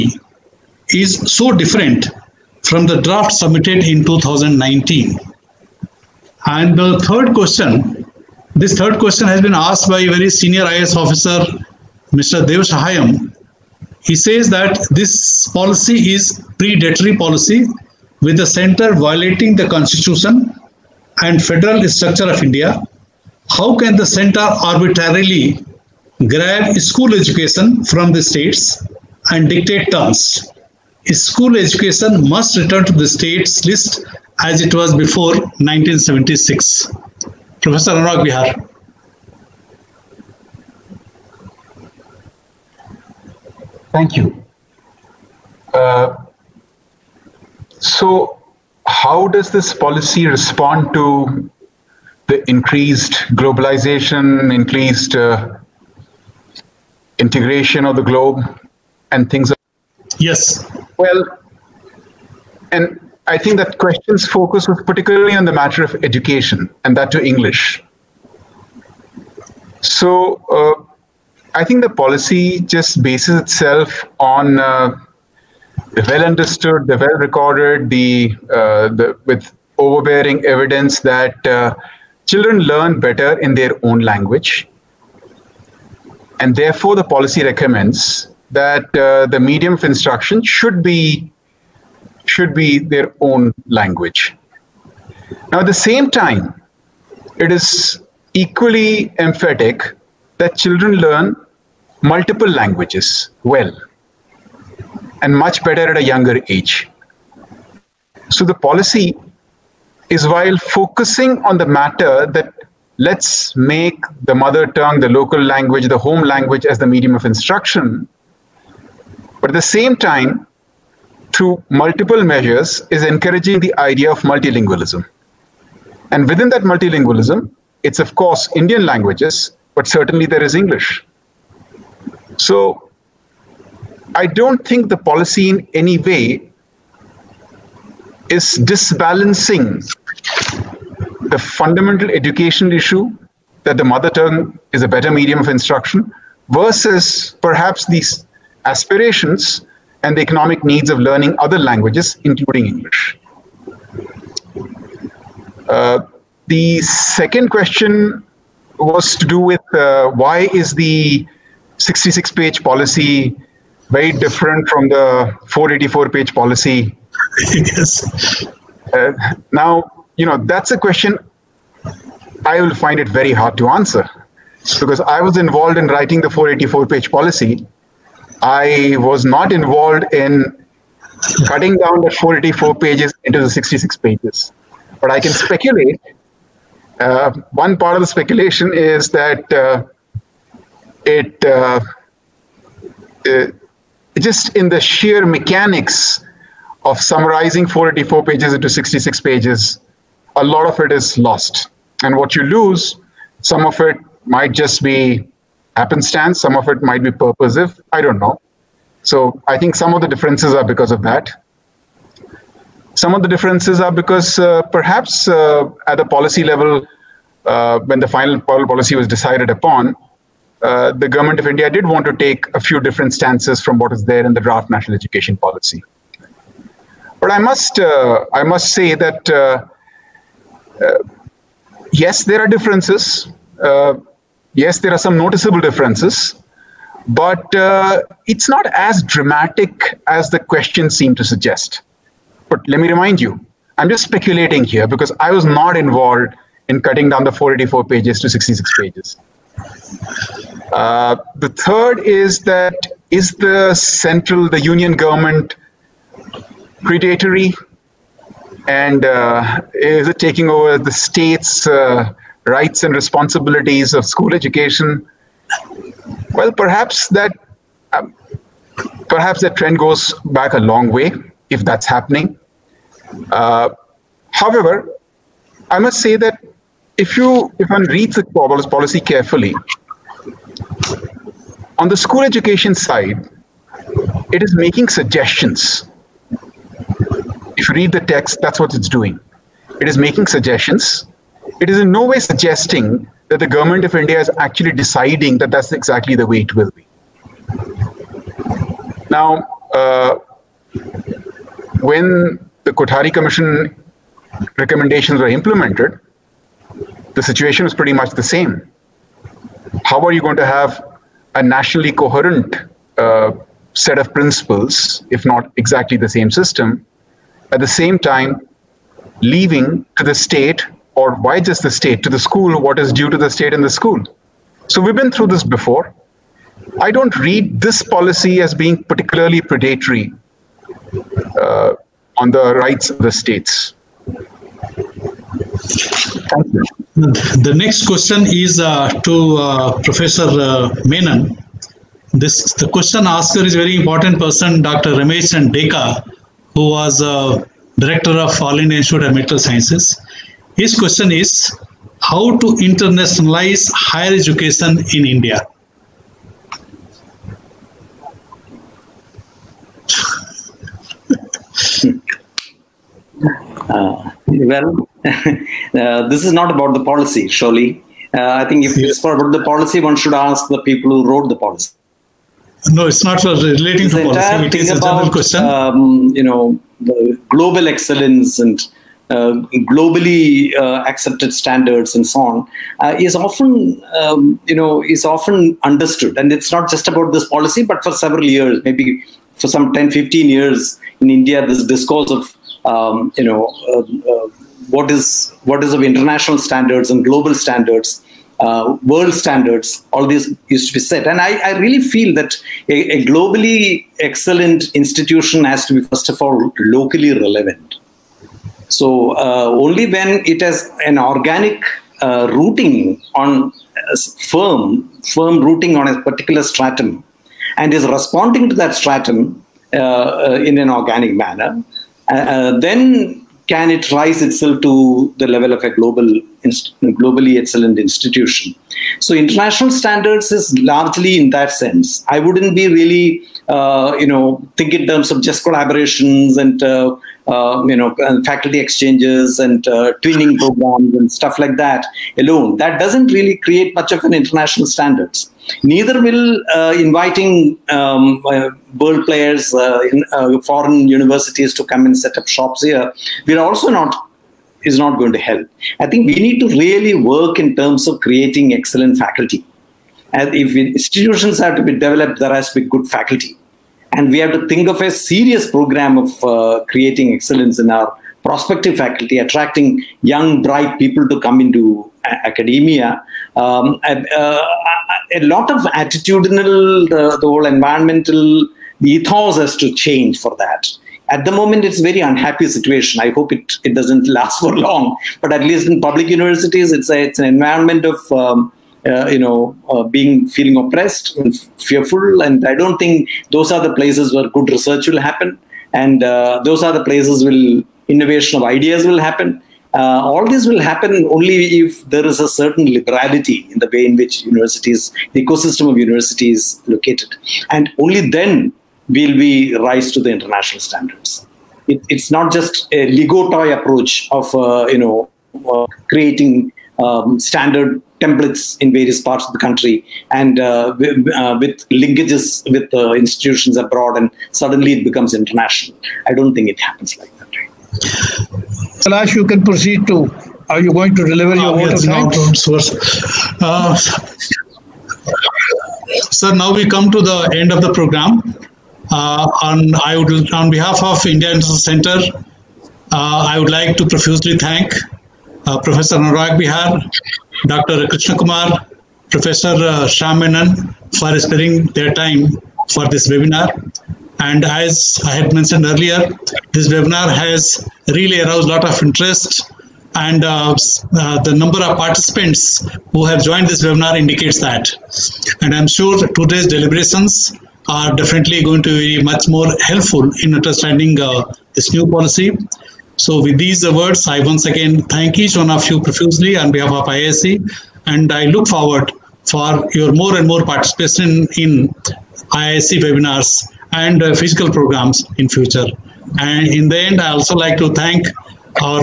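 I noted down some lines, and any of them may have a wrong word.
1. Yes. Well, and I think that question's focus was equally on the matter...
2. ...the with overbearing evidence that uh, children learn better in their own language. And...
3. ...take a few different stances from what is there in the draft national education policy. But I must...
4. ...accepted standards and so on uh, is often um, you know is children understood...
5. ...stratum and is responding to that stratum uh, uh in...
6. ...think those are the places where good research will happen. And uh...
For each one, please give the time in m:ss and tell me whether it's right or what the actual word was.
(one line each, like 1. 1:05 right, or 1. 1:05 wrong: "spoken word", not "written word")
1. 1:00 wrong: "particularly", not "equally"
2. 1:18 right
3. 3:42 right
4. 6:20 wrong: "often", not "children"
5. 6:56 right
6. 8:12 right.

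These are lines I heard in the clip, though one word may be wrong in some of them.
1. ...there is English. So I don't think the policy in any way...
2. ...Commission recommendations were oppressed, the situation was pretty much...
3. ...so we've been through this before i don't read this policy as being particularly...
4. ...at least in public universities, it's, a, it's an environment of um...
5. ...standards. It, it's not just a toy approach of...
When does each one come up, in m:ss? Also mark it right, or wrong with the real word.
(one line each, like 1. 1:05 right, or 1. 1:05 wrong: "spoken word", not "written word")
1. 2:10 right
2. 5:03 wrong: "implemented", not "oppressed"
3. 5:24 right
4. 8:05 right
5. 8:30 right.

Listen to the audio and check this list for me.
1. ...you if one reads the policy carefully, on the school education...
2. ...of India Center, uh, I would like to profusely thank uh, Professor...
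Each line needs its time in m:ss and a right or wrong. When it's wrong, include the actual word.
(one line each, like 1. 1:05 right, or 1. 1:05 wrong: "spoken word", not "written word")
1. 4:37 right
2. 9:00 right.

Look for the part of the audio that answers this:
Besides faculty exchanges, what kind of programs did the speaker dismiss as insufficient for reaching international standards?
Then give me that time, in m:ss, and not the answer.
7:20.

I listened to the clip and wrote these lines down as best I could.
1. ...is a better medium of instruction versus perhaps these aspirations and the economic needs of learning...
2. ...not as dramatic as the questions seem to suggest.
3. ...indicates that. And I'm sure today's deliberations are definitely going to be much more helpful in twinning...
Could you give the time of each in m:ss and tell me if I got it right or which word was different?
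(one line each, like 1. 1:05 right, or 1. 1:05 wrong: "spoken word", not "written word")
1. 2:24 right
2. 3:58 right
3. 9:23 wrong: "understanding", not "twinning".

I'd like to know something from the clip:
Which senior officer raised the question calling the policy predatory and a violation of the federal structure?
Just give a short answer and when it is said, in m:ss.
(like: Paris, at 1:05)
Dev Shahayam, at 0:12.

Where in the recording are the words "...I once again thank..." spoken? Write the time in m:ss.
9:34.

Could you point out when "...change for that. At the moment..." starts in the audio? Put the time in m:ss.
7:59.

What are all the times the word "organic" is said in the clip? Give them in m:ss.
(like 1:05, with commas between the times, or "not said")
6:50, 7:00.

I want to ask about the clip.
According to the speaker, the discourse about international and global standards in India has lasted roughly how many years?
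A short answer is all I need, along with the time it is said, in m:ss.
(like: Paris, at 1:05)
10 to 15 years, at 6:29.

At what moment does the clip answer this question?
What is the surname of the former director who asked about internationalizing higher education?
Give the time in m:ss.
5:45.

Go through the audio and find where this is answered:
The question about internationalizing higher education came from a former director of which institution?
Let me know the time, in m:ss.
5:48.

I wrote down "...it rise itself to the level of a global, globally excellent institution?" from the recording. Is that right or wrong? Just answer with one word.
right.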